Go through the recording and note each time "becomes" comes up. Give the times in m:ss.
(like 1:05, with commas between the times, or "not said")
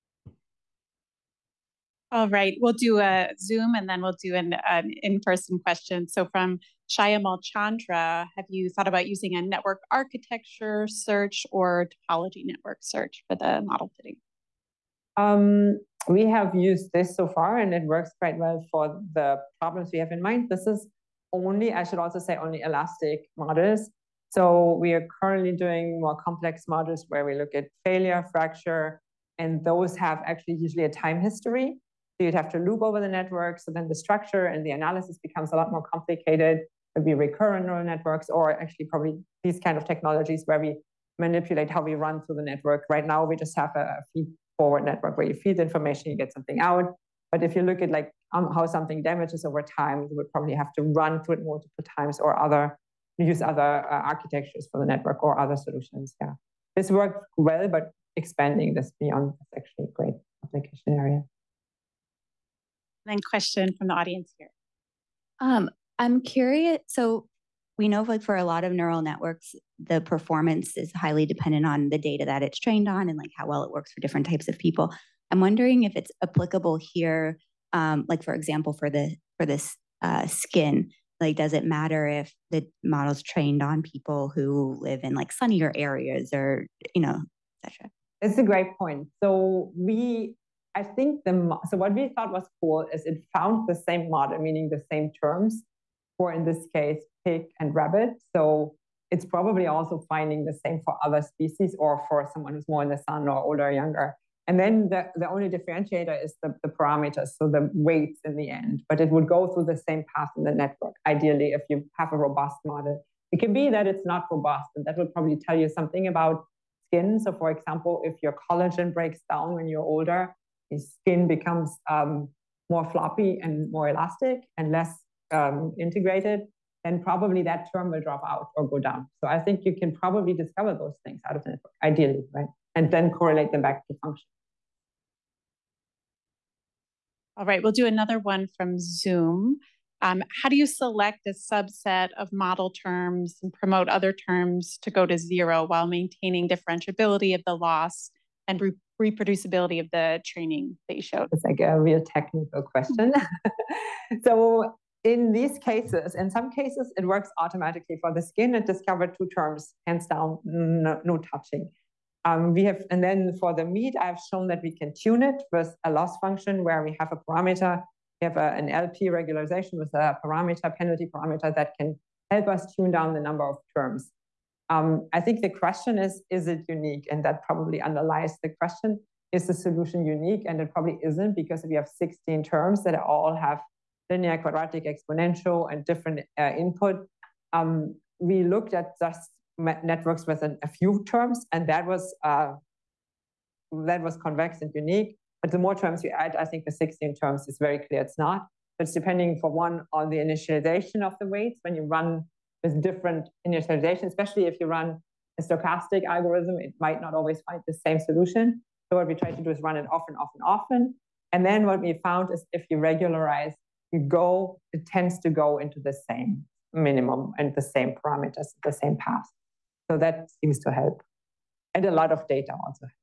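0:35, 2:01.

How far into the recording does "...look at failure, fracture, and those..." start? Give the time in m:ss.
0:27.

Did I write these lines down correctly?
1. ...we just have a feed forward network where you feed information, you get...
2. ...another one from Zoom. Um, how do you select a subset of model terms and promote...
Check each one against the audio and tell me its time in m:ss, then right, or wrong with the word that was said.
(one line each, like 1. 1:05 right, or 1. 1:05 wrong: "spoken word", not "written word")
1. 0:43 right
2. 2:17 right.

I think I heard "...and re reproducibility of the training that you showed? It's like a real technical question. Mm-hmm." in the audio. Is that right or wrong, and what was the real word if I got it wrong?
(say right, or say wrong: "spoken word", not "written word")
right.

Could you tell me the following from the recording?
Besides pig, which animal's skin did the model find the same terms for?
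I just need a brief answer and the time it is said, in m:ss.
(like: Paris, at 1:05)
rabbit, at 1:37.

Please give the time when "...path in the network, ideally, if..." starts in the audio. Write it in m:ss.
1:50.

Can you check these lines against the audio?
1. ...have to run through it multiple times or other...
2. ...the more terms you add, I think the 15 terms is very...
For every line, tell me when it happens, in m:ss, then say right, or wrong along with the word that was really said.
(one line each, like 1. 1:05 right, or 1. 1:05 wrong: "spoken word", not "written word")
1. 0:50 right
2. 3:15 wrong: "16", not "15".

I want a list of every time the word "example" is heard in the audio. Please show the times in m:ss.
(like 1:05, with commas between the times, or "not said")
1:18, 1:57.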